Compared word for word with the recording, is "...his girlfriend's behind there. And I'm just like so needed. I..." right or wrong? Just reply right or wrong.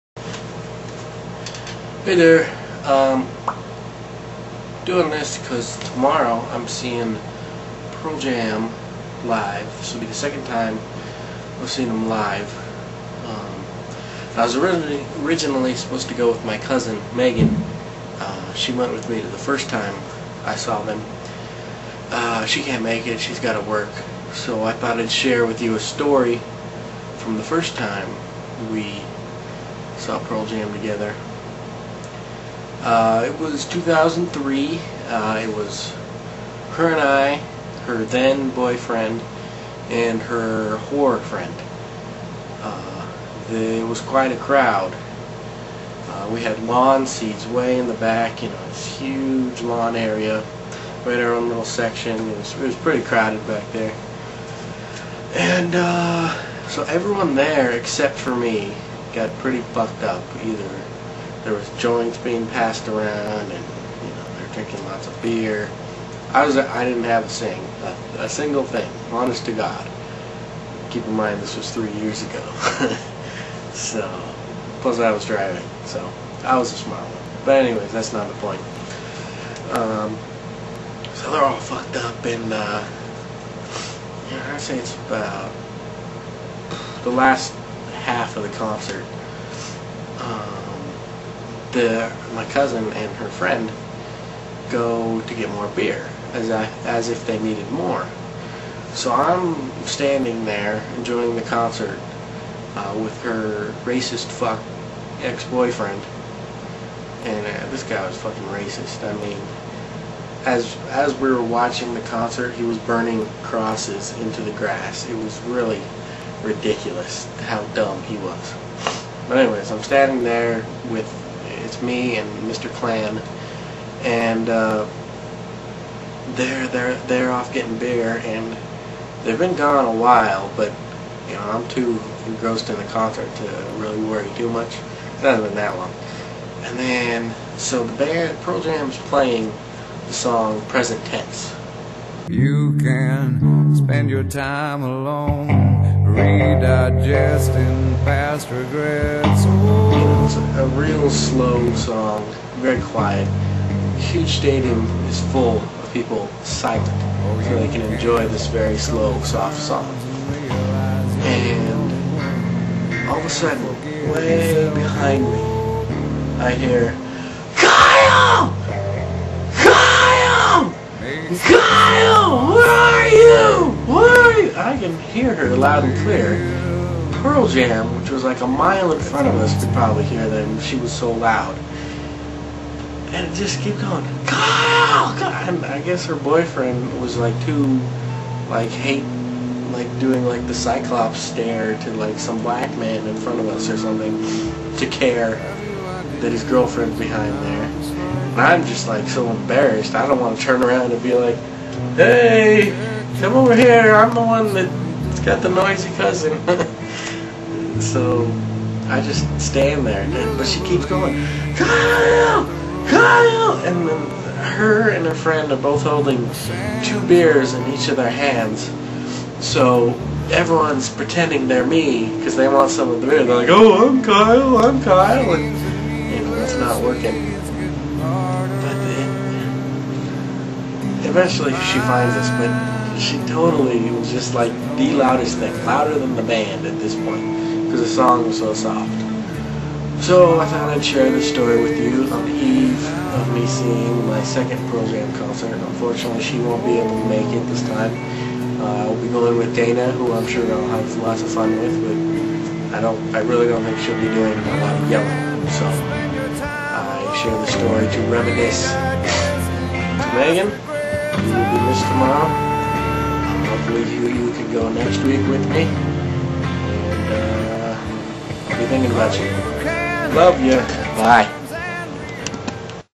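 wrong.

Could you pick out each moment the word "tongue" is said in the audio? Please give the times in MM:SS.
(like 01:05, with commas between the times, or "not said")
not said.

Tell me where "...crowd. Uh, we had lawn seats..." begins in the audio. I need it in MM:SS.
00:44.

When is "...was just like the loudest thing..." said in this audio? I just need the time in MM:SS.
03:53.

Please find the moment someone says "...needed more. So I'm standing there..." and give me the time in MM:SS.
01:37.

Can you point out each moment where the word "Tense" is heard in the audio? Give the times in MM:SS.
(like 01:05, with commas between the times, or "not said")
02:21.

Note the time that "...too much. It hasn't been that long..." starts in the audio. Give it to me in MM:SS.
02:14.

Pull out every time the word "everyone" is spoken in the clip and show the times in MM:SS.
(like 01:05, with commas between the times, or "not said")
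00:56, 03:40.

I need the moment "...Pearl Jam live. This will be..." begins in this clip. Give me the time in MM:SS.
00:07.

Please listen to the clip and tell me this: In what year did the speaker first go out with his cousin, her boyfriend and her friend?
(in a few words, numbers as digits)
2003.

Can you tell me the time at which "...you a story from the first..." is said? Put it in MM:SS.
00:25.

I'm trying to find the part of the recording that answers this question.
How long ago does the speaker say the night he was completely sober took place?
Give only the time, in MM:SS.
01:11.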